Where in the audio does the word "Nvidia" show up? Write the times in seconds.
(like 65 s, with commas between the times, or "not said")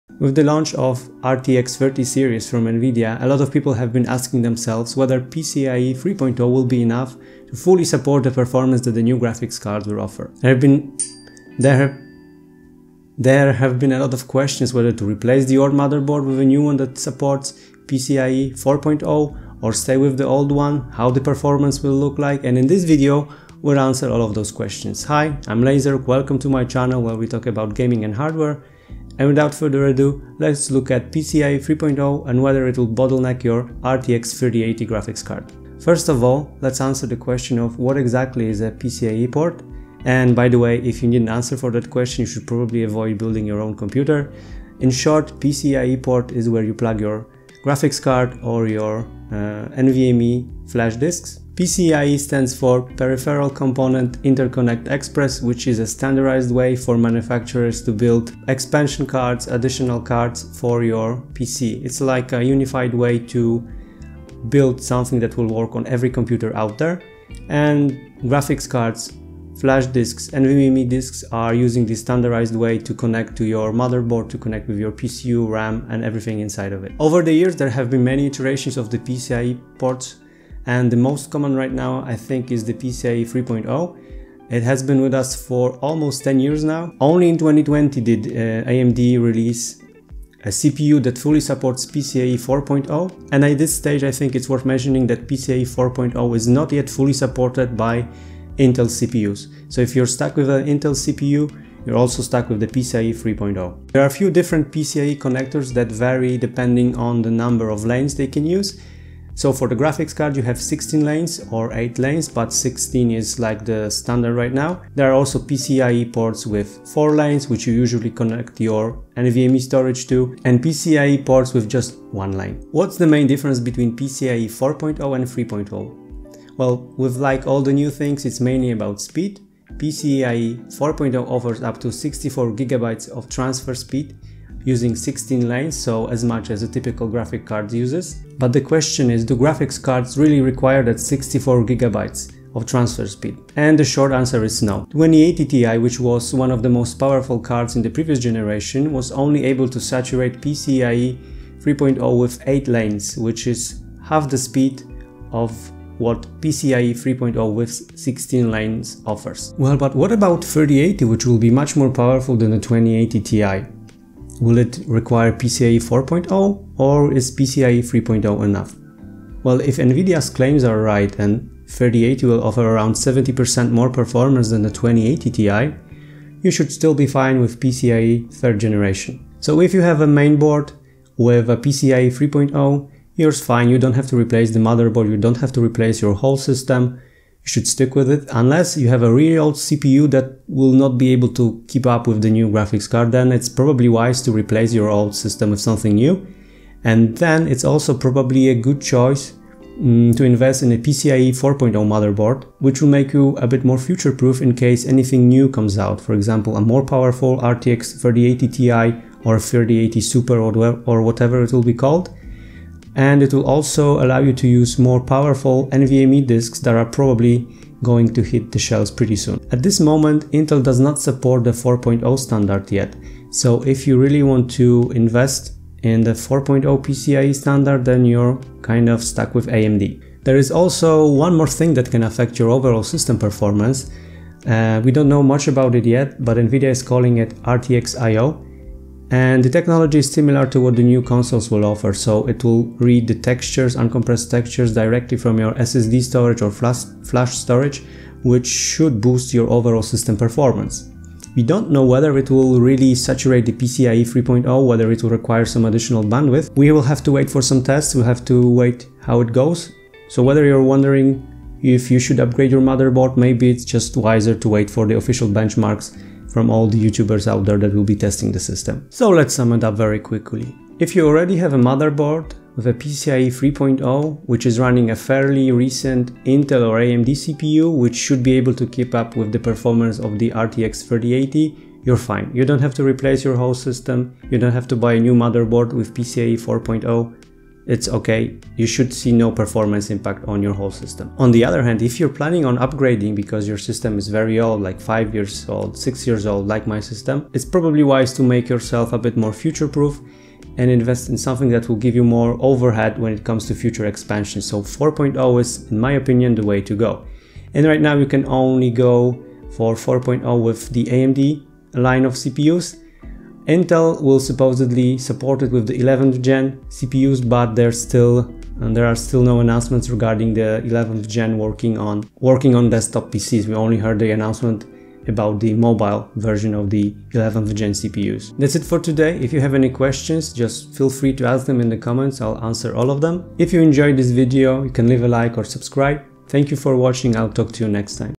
2 s, 169 s, 236 s.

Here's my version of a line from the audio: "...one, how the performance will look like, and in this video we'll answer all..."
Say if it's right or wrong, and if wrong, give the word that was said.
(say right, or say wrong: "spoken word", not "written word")
right.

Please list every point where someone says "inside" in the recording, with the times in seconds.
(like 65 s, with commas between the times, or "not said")
76 s.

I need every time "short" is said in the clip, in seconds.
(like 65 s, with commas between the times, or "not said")
44 s, 143 s.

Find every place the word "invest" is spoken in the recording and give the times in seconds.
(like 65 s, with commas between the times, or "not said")
200 s, 224 s, 300 s.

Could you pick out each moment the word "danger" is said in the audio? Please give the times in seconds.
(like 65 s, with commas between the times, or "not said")
not said.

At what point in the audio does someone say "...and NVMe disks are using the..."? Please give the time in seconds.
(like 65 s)
70 s.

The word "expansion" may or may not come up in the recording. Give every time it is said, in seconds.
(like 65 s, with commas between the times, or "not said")
58 s, 303 s.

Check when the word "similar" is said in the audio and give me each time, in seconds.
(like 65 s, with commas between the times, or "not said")
240 s.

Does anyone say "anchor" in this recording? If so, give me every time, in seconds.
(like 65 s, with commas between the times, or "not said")
not said.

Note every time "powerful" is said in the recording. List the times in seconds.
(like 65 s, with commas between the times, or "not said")
146 s, 161 s, 206 s, 214 s.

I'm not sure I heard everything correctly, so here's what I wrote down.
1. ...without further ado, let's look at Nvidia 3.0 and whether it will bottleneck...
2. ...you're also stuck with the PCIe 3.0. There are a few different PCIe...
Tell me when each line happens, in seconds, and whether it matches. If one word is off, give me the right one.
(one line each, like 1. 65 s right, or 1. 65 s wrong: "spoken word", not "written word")
1. 29 s wrong: "PCIe", not "Nvidia"
2. 101 s right.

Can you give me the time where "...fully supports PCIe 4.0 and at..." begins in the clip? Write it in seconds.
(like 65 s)
91 s.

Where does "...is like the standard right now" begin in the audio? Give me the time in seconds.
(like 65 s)
113 s.